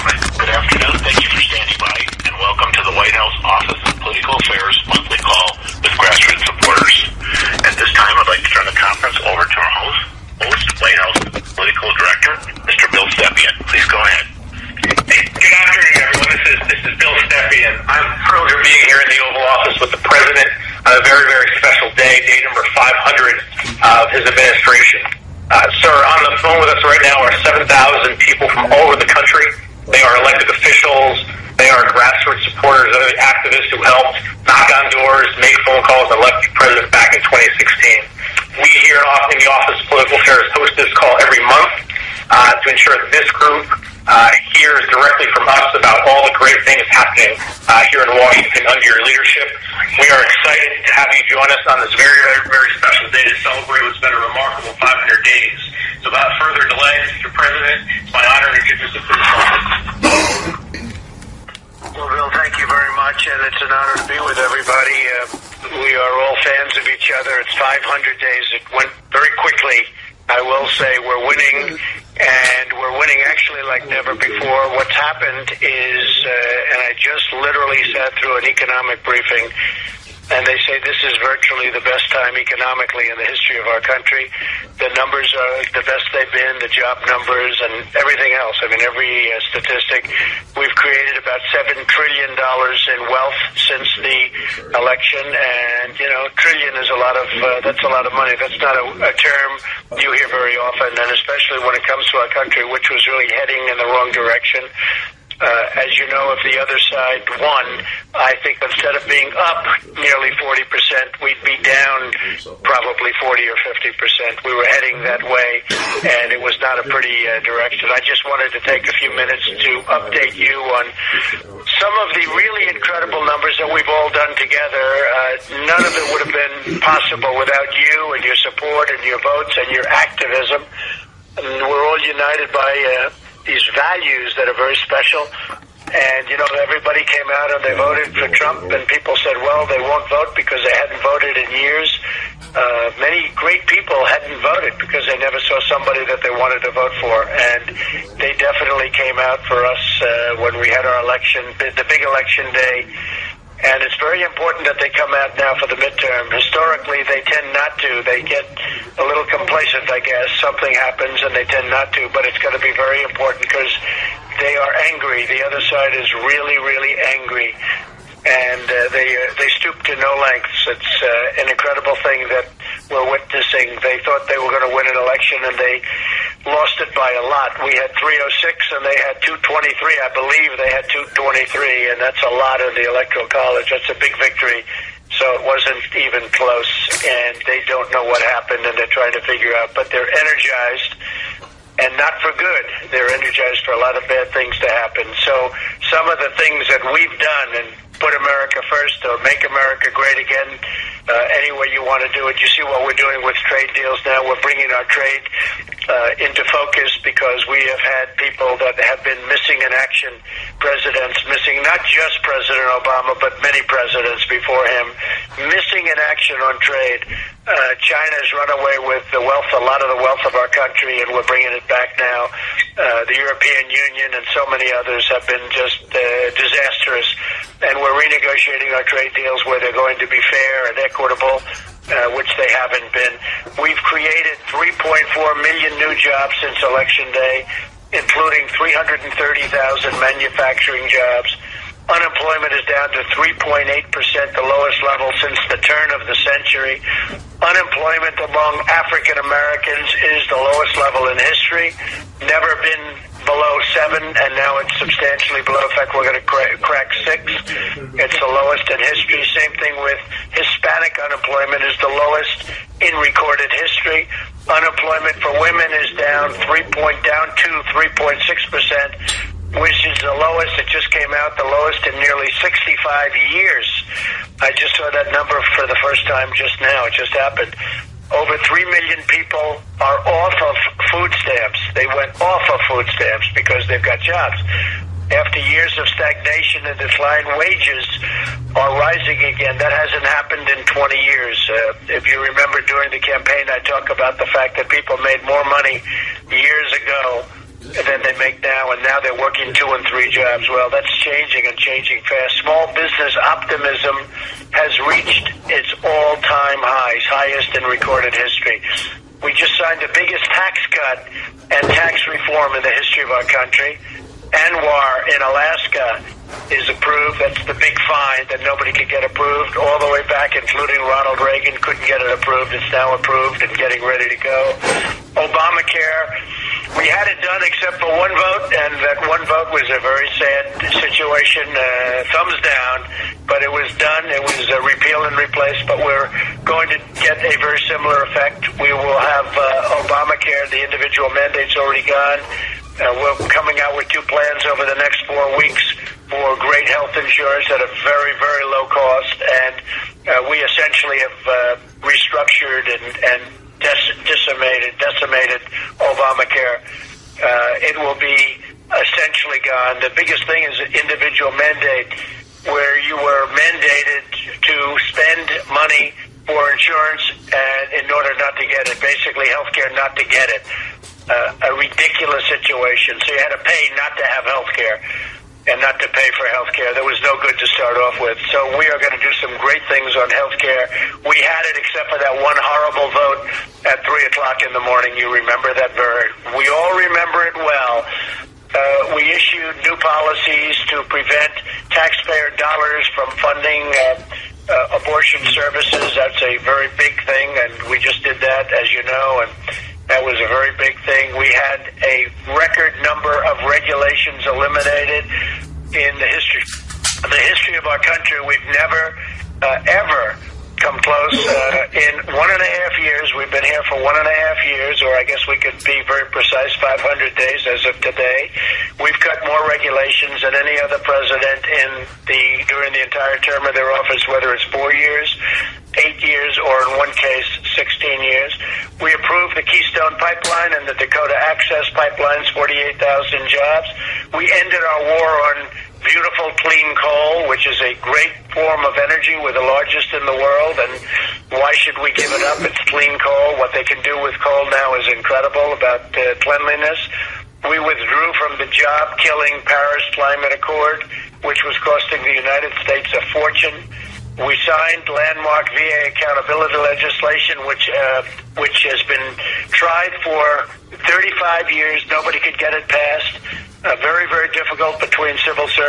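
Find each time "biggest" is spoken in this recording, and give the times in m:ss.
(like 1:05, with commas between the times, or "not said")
5:09, 5:59.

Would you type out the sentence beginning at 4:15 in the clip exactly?
In fact, we're going to crack six.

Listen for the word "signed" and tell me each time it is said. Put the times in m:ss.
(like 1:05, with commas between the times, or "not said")
5:09, 7:34.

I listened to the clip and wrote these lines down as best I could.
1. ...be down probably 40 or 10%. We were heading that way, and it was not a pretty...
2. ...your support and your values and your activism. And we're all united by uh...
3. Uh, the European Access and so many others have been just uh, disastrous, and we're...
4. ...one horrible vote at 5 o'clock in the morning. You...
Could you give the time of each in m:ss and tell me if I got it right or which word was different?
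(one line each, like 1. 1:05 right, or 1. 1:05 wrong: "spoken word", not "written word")
1. 1:51 wrong: "50", not "10"
2. 2:08 wrong: "votes", not "values"
3. 3:42 wrong: "Union", not "Access"
4. 6:22 wrong: "3", not "5".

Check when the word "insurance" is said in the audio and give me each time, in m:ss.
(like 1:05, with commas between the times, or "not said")
5:46, 6:06.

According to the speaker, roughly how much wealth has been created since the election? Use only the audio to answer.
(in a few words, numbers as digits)
7 trillion dollars.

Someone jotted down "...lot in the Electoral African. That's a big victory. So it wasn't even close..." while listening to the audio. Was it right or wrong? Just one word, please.
wrong.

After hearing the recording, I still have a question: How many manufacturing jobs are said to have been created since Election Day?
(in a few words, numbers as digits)
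330,000.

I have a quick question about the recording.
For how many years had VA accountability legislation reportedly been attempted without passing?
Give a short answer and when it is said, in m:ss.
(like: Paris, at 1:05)
35 years, at 7:40.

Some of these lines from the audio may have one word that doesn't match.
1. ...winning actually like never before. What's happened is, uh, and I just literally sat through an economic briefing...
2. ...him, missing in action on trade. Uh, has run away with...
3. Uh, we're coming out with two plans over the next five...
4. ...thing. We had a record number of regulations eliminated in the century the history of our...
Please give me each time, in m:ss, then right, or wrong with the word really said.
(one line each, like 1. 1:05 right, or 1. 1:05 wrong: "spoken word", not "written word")
1. 1:12 right
2. 3:34 right
3. 5:42 wrong: "four", not "five"
4. 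6:40 wrong: "history", not "century".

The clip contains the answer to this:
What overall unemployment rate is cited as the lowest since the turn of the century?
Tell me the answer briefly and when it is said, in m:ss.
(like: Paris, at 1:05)
3.8%, at 4:03.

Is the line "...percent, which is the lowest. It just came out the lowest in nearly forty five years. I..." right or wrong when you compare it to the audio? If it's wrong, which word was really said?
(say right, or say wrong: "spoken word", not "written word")
wrong: "sixty", not "forty".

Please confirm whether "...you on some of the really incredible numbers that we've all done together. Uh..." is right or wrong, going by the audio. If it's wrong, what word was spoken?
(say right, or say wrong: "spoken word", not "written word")
right.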